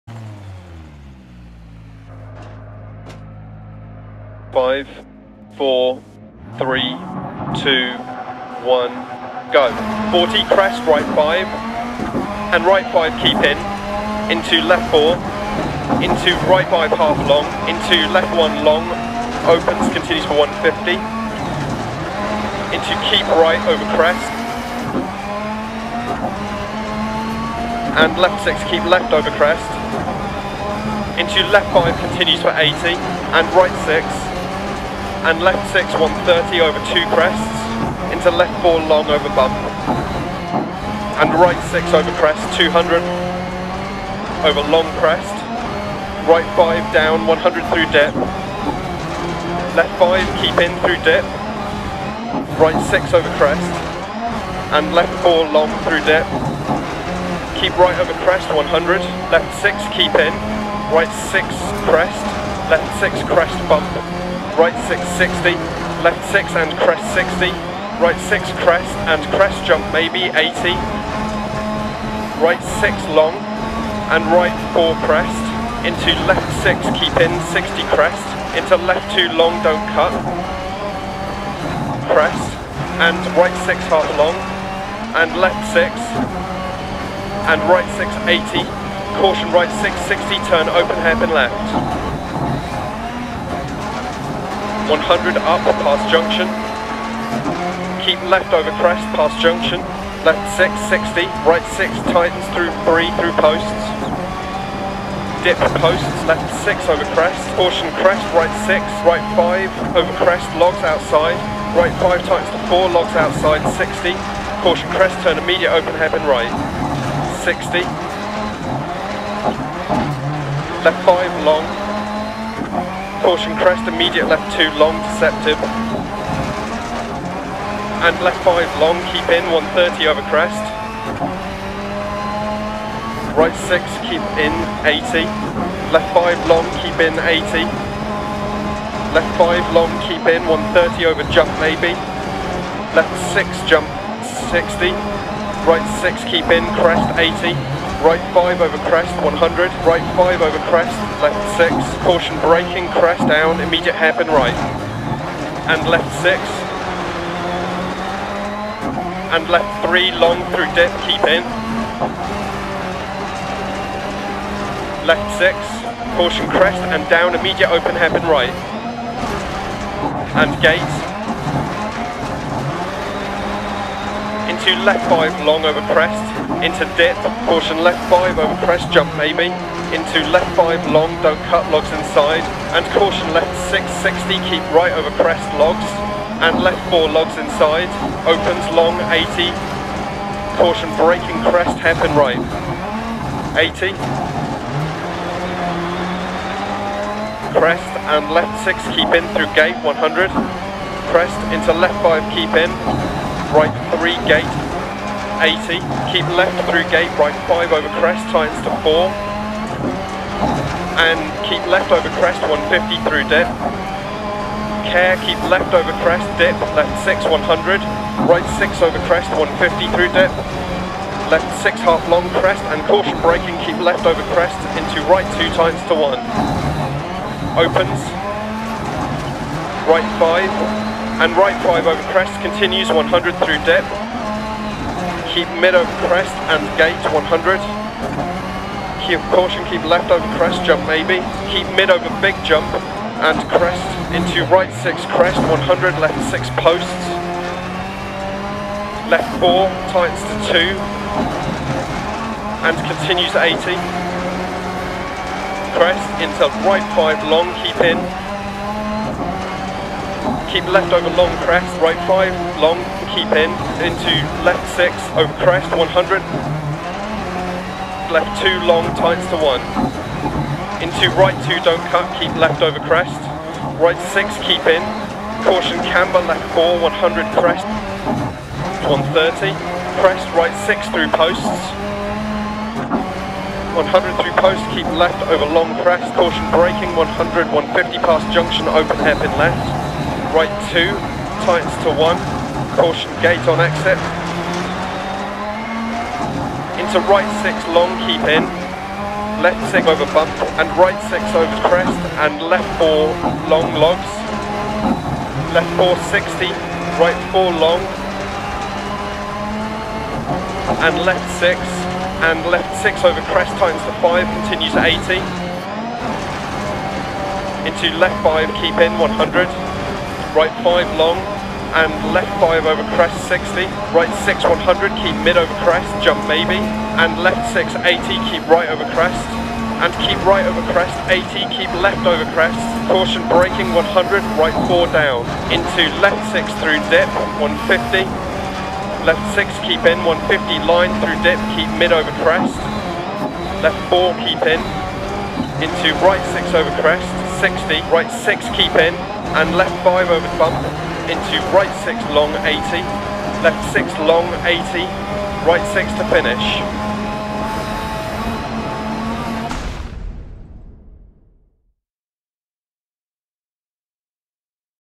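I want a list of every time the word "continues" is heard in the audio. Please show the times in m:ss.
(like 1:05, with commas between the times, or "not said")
0:19, 0:32, 3:52, 4:12, 5:14.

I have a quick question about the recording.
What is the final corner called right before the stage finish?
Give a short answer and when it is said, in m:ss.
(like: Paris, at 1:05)
right 6, at 5:55.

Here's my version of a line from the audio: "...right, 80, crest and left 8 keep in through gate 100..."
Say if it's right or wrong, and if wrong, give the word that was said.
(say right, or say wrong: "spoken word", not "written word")
wrong: "6", not "8".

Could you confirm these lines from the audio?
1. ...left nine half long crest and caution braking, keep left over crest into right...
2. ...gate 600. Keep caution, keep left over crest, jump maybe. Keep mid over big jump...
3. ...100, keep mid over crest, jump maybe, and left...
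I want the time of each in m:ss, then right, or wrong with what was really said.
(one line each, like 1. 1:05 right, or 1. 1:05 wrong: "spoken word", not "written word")
1. 3:41 wrong: "six", not "nine"
2. 3:56 wrong: "100", not "600"
3. 5:24 right.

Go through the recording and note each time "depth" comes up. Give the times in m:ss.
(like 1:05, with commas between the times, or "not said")
3:53.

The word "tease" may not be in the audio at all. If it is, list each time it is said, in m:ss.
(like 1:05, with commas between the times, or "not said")
not said.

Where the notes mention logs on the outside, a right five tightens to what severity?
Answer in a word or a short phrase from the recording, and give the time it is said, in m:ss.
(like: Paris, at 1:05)
4, at 1:51.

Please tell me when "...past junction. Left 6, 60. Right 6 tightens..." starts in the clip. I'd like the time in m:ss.
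1:39.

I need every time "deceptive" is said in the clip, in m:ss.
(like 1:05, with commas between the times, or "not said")
2:05.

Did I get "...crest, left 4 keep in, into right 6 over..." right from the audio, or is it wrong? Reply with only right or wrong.
right.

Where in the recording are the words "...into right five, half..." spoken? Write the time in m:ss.
0:16.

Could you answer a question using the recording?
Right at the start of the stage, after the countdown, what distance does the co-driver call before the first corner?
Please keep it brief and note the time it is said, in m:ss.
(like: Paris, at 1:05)
40, at 0:10.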